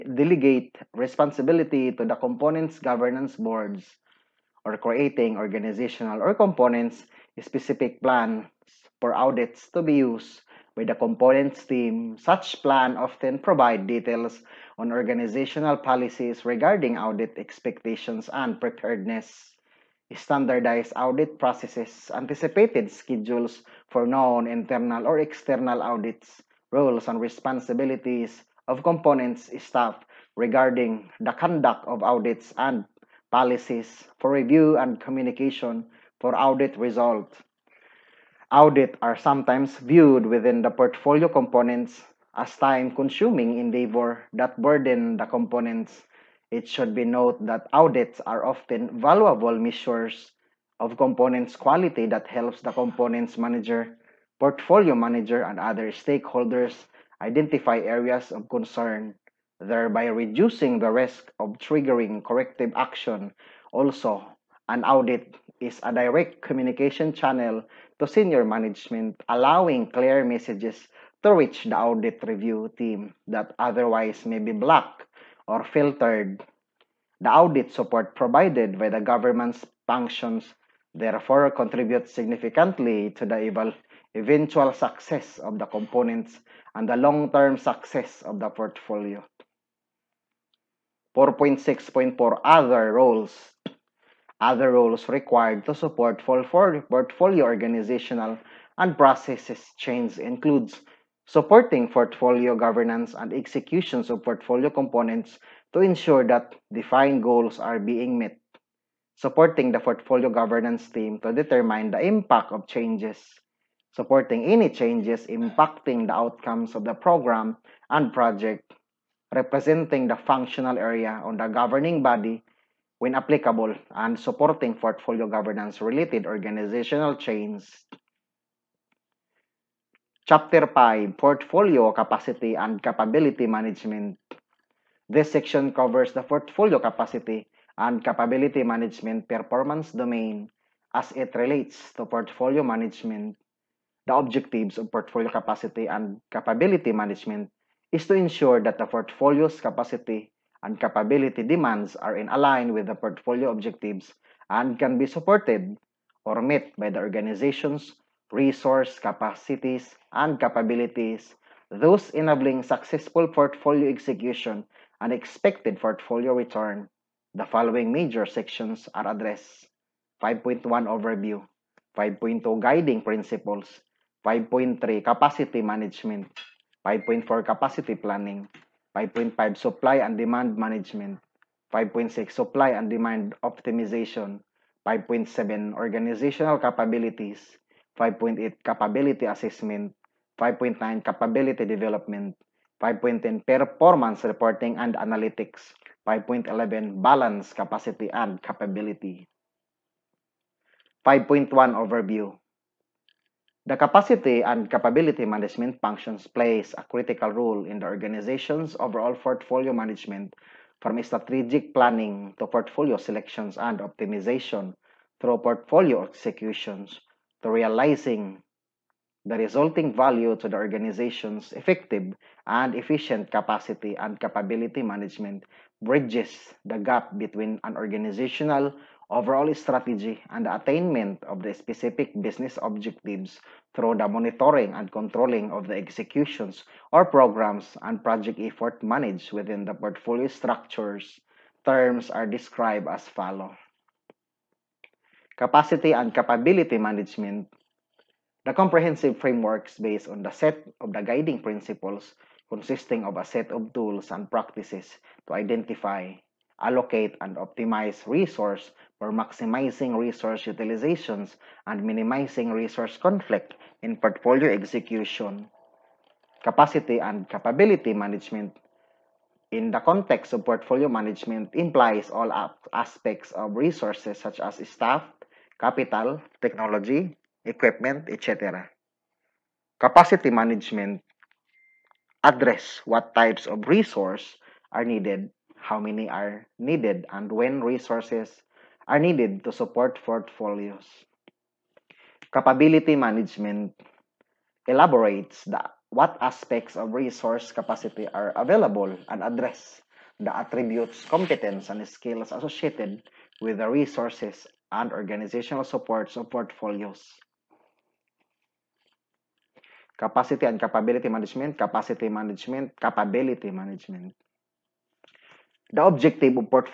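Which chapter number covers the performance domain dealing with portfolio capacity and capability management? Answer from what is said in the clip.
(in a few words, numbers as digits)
5.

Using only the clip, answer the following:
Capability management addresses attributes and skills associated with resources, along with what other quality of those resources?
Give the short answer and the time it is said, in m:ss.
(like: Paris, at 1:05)
competence, at 5:01.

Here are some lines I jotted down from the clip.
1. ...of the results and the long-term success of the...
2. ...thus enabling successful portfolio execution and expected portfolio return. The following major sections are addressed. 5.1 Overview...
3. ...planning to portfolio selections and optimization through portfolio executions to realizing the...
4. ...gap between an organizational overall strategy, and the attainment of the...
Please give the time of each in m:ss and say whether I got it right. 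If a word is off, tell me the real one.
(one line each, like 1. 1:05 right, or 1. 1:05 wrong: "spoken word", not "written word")
1. 1:25 wrong: "components", not "results"
2. 2:41 right
3. 3:31 right
4. 3:46 right.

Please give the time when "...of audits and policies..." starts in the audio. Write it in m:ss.
0:31.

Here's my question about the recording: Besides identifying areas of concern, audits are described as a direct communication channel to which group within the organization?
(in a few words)
senior management.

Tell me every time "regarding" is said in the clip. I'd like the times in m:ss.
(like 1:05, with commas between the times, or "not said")
0:16, 0:30.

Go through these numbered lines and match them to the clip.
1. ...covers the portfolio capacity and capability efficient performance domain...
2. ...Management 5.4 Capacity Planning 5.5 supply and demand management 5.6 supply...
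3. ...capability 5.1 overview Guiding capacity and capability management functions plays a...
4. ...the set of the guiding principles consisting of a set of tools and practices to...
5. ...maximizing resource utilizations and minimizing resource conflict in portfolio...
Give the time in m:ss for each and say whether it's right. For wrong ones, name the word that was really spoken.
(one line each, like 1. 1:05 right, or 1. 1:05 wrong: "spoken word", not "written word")
1. 2:15 wrong: "management", not "efficient"
2. 2:55 right
3. 3:18 wrong: "The", not "Guiding"
4. 4:10 right
5. 4:19 right.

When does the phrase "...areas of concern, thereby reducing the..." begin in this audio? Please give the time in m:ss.
0:57.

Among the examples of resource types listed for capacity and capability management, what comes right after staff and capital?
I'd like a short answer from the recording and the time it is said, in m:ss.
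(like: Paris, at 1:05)
technology, at 4:36.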